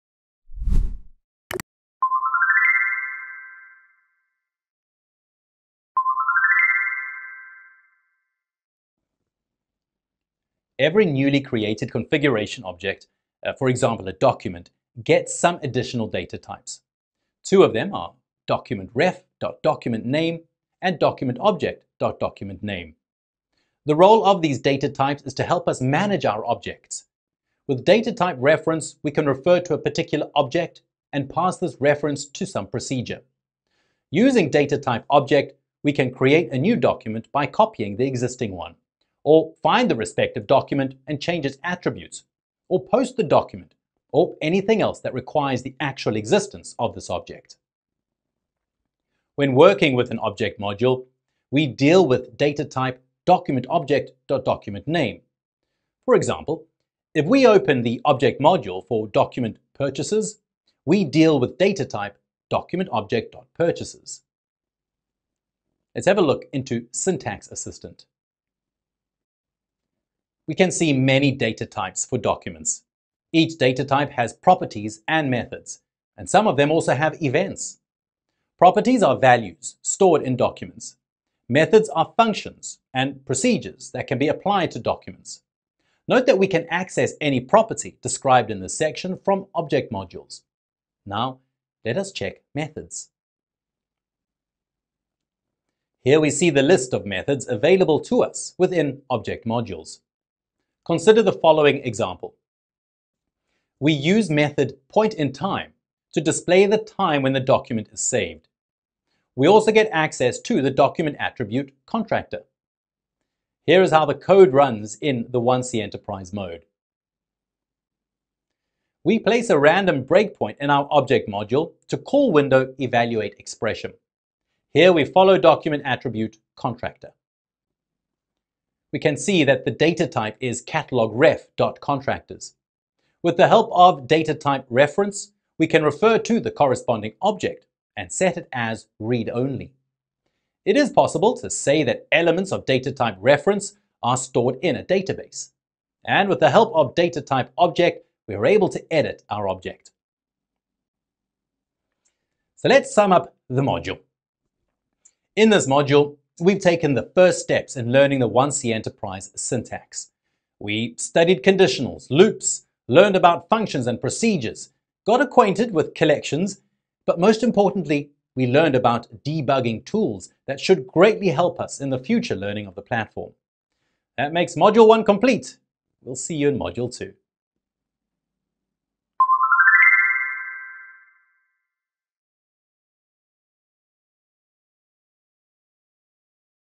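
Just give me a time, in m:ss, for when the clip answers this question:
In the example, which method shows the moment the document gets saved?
1:44.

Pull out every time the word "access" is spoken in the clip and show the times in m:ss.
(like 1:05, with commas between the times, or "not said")
1:26, 1:49.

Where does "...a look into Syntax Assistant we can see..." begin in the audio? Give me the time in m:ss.
1:06.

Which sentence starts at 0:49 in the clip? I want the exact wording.
When working with an object module, we deal with data type document object document name.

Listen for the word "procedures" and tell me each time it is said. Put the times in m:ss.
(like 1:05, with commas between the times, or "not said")
0:32, 1:23, 2:44.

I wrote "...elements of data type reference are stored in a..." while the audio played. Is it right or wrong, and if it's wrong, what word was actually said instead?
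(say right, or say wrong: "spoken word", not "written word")
right.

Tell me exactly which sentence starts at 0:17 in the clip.
Two of them are documentRef.documentName and documentObject.documentName.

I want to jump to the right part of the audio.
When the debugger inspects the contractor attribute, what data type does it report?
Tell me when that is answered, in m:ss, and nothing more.
2:10.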